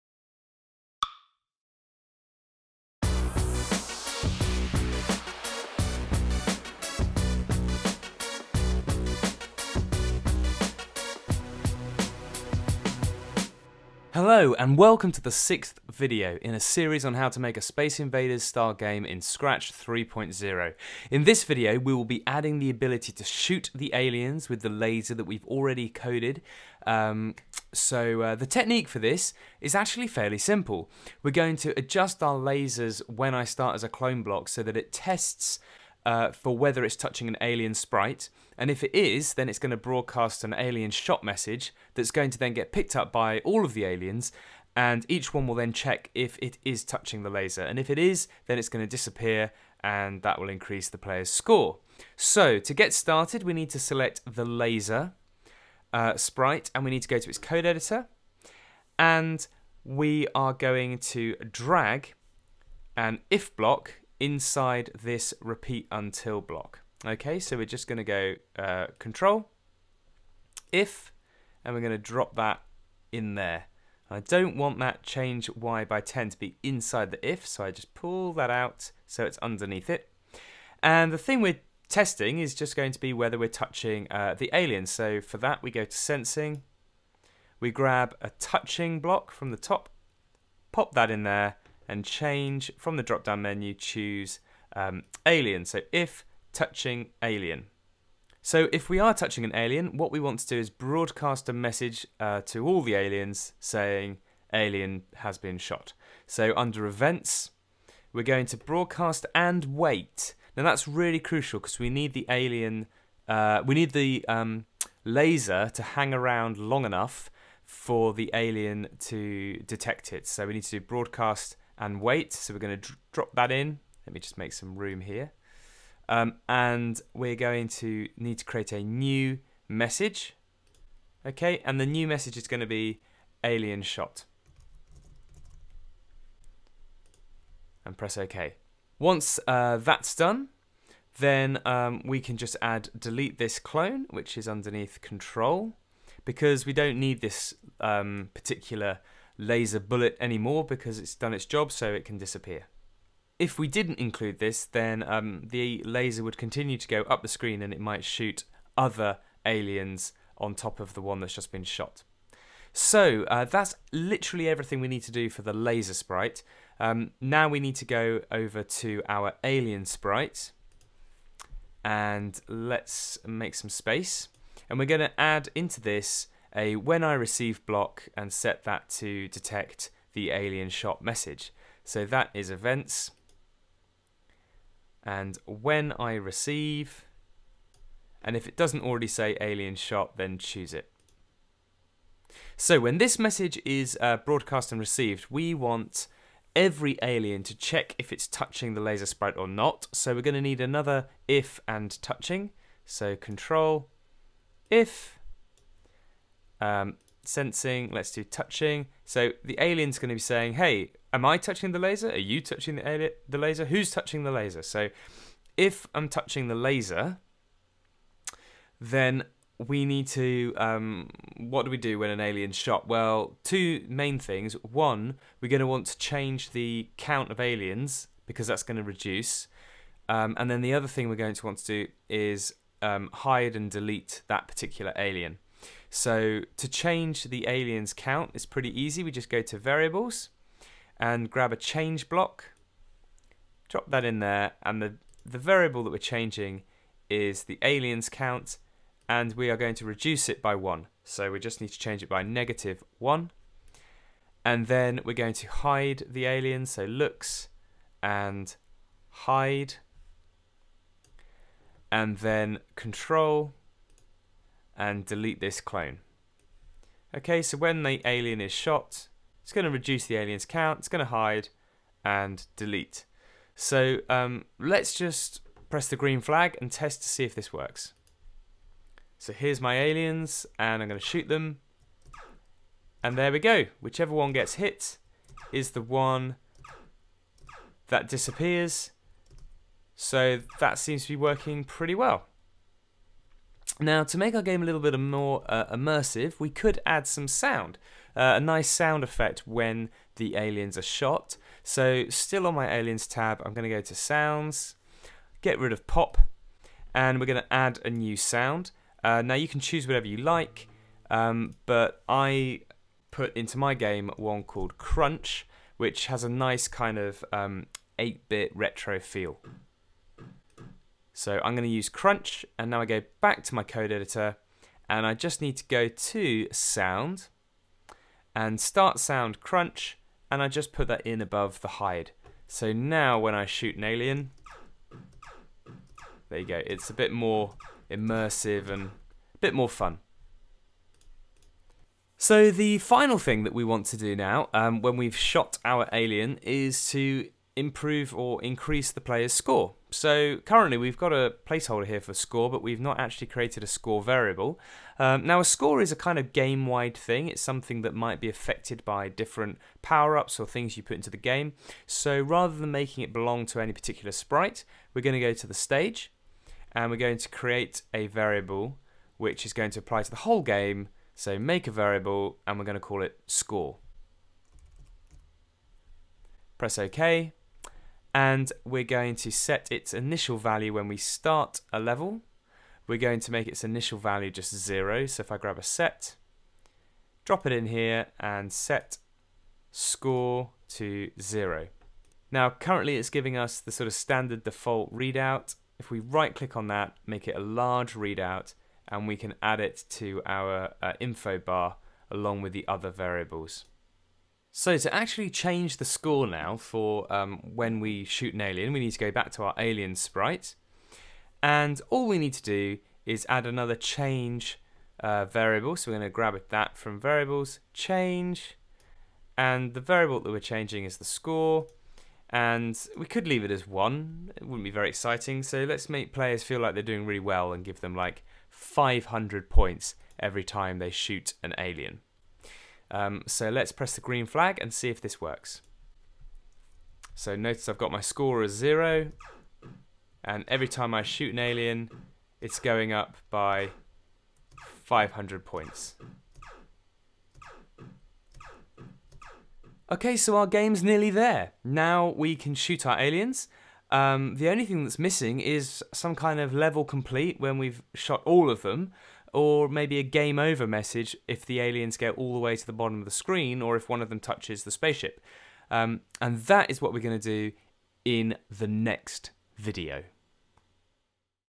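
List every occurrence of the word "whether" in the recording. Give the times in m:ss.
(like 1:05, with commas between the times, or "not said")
0:36, 1:23.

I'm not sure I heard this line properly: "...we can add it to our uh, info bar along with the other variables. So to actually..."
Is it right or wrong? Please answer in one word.
right.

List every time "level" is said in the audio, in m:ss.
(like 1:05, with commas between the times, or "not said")
6:21, 7:36.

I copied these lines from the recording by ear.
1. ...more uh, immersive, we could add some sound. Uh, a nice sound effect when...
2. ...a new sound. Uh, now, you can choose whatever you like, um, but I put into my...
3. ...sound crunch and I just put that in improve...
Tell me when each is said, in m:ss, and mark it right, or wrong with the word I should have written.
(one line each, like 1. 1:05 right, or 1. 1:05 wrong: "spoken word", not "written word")
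1. 4:54 right
2. 5:07 right
3. 5:28 wrong: "above", not "improve".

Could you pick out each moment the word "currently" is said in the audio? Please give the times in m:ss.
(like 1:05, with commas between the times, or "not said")
5:50, 6:32.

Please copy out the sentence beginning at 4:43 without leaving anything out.
Whichever one gets hit is the one that disappears.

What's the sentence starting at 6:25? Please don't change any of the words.
So if I grab a set, drop it in here and set score to zero.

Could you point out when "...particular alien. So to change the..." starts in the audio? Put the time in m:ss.
3:54.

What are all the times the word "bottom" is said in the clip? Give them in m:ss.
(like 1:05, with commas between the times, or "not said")
7:42.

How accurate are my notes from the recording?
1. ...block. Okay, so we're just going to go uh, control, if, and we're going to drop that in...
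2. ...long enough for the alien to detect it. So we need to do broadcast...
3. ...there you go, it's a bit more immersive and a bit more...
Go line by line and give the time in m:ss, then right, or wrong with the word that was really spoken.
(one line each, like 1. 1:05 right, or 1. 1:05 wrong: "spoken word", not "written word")
1. 1:06 right
2. 1:56 right
3. 5:36 right.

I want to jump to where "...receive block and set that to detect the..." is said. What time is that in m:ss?
2:57.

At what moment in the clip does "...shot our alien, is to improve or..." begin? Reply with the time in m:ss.
5:45.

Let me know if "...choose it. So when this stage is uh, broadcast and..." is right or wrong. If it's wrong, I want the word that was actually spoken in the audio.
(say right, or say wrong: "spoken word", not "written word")
wrong: "message", not "stage".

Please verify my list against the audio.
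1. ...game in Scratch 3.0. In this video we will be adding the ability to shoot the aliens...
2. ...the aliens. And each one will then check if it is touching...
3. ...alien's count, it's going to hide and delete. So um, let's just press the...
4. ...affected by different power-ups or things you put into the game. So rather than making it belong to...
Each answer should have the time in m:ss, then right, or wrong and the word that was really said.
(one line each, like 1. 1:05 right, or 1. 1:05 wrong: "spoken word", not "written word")
1. 0:18 right
2. 0:43 right
3. 4:30 right
4. 5:58 right.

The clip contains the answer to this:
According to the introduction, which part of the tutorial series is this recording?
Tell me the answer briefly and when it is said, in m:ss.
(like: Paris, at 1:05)
sixth, at 0:15.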